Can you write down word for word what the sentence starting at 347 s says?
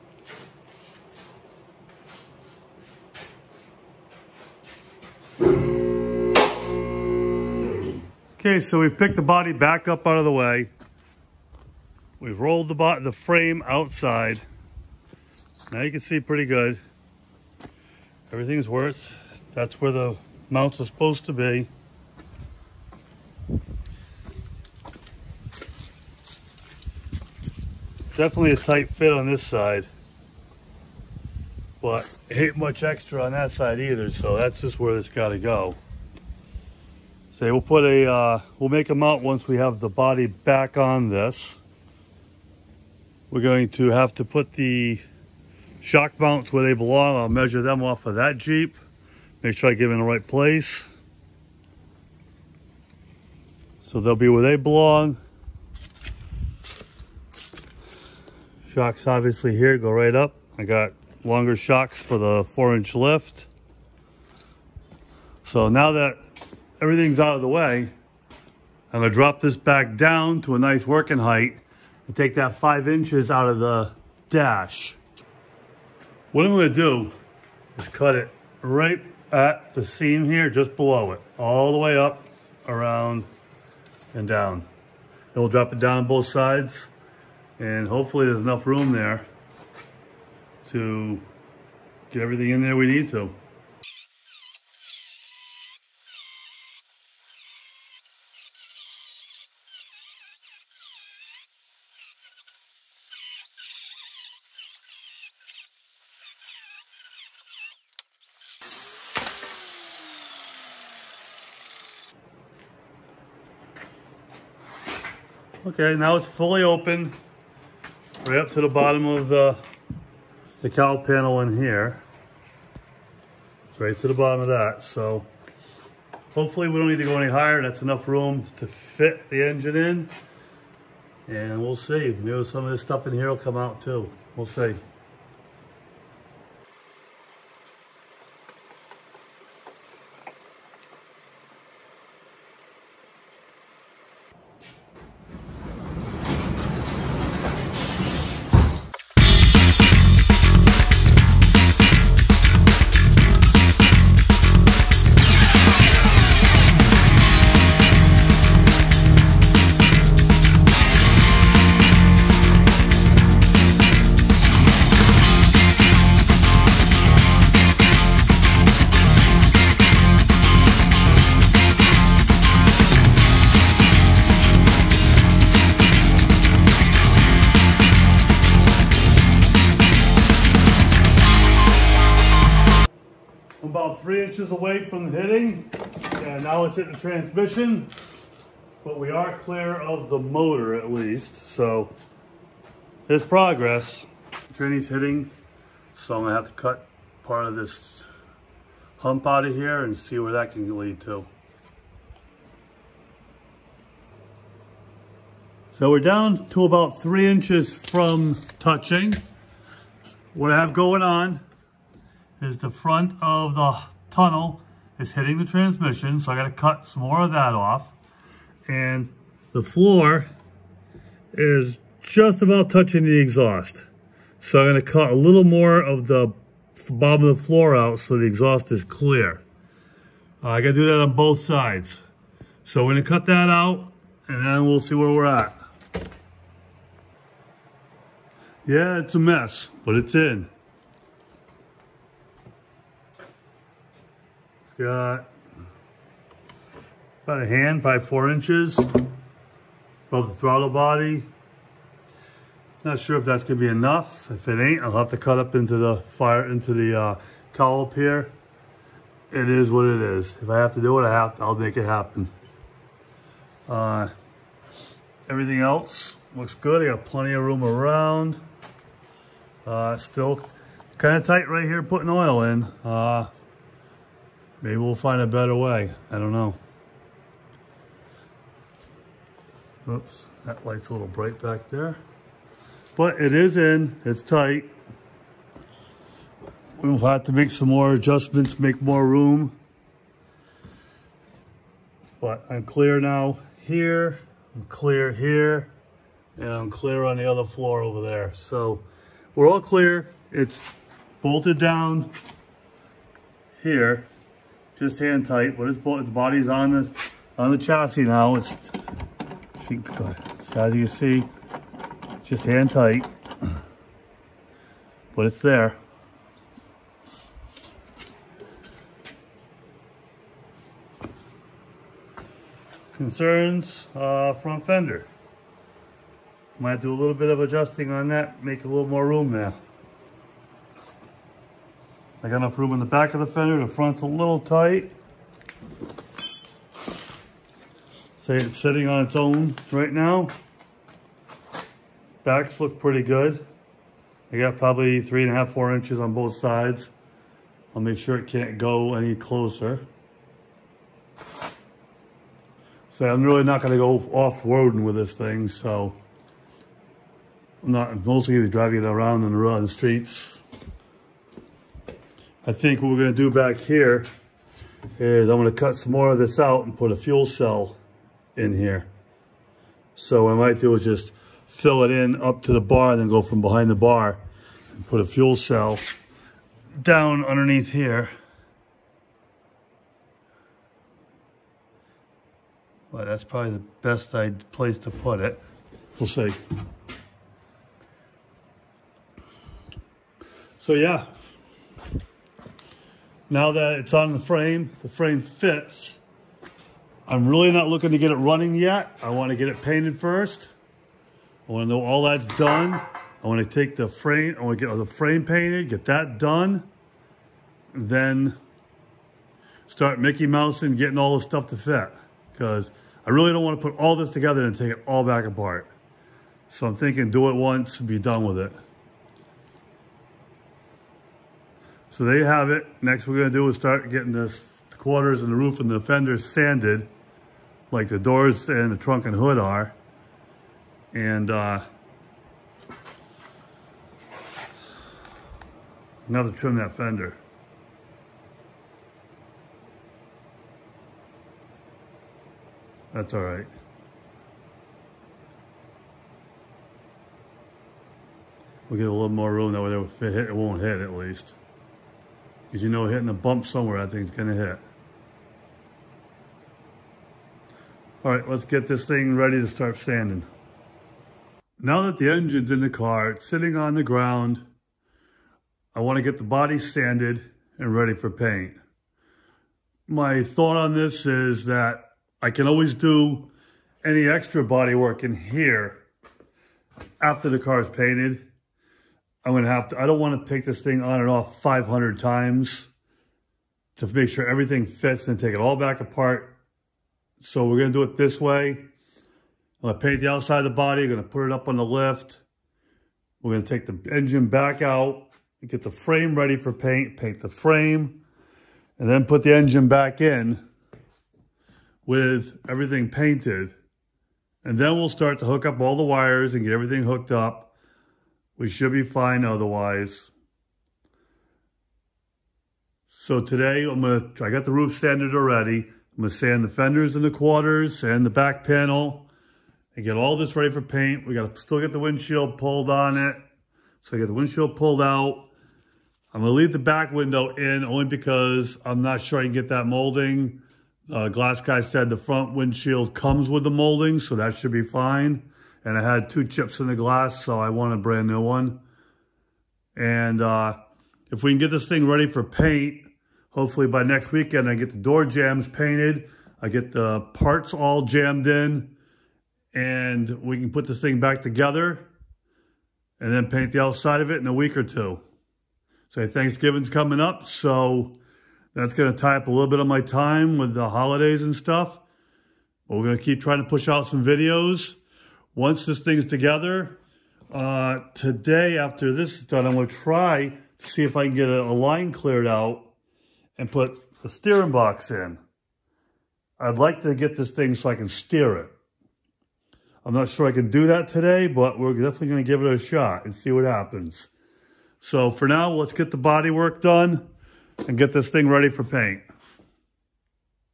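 I'll make sure it can't go any closer.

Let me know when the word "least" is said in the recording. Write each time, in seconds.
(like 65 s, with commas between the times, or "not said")
190 s, 450 s.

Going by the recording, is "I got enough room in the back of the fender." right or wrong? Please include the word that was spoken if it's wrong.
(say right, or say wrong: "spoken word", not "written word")
right.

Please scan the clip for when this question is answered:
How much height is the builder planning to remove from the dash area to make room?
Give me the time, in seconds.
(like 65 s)
72 s.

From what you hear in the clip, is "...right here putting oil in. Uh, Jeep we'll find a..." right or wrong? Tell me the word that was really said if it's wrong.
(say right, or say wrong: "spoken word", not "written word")
wrong: "Maybe", not "Jeep".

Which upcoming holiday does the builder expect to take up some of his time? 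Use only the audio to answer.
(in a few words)
Thanksgiving.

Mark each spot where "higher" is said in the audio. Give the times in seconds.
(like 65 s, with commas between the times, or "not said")
127 s.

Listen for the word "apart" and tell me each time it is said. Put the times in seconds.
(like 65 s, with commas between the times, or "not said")
415 s, 485 s.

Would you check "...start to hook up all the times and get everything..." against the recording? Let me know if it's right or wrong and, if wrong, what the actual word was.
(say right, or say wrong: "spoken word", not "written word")
wrong: "wires", not "times".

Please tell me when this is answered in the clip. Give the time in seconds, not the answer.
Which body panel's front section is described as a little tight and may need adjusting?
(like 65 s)
324 s.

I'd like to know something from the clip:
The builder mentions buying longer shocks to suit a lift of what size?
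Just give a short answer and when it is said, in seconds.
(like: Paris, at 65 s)
4 inch, at 62 s.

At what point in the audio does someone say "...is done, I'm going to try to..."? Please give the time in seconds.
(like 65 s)
569 s.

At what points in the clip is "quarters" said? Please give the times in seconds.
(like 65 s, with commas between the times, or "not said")
424 s, 517 s.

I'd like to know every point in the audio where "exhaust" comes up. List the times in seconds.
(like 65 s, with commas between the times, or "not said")
223 s, 228 s.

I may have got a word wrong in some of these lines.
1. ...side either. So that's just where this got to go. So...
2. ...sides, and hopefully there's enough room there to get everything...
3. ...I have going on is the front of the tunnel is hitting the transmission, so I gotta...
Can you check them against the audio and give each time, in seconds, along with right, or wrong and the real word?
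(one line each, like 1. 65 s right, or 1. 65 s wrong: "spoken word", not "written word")
1. 33 s right
2. 86 s right
3. 210 s right.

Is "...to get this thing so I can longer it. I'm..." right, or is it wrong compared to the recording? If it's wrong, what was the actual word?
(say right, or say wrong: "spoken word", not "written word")
wrong: "steer", not "longer".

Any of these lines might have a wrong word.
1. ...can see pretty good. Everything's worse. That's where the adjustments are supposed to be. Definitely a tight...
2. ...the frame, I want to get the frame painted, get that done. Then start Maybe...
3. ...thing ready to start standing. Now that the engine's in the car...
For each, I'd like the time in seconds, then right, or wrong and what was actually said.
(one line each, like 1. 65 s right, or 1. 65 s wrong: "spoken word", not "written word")
1. 15 s wrong: "mounts", not "adjustments"
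2. 403 s wrong: "Mickey", not "Maybe"
3. 458 s right.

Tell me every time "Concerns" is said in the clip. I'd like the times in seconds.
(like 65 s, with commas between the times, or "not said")
322 s.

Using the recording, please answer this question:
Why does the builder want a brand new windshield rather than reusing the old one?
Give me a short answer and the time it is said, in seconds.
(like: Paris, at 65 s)
two chips, at 536 s.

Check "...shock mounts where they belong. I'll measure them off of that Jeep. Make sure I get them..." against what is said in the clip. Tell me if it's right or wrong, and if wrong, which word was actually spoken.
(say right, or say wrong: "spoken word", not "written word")
right.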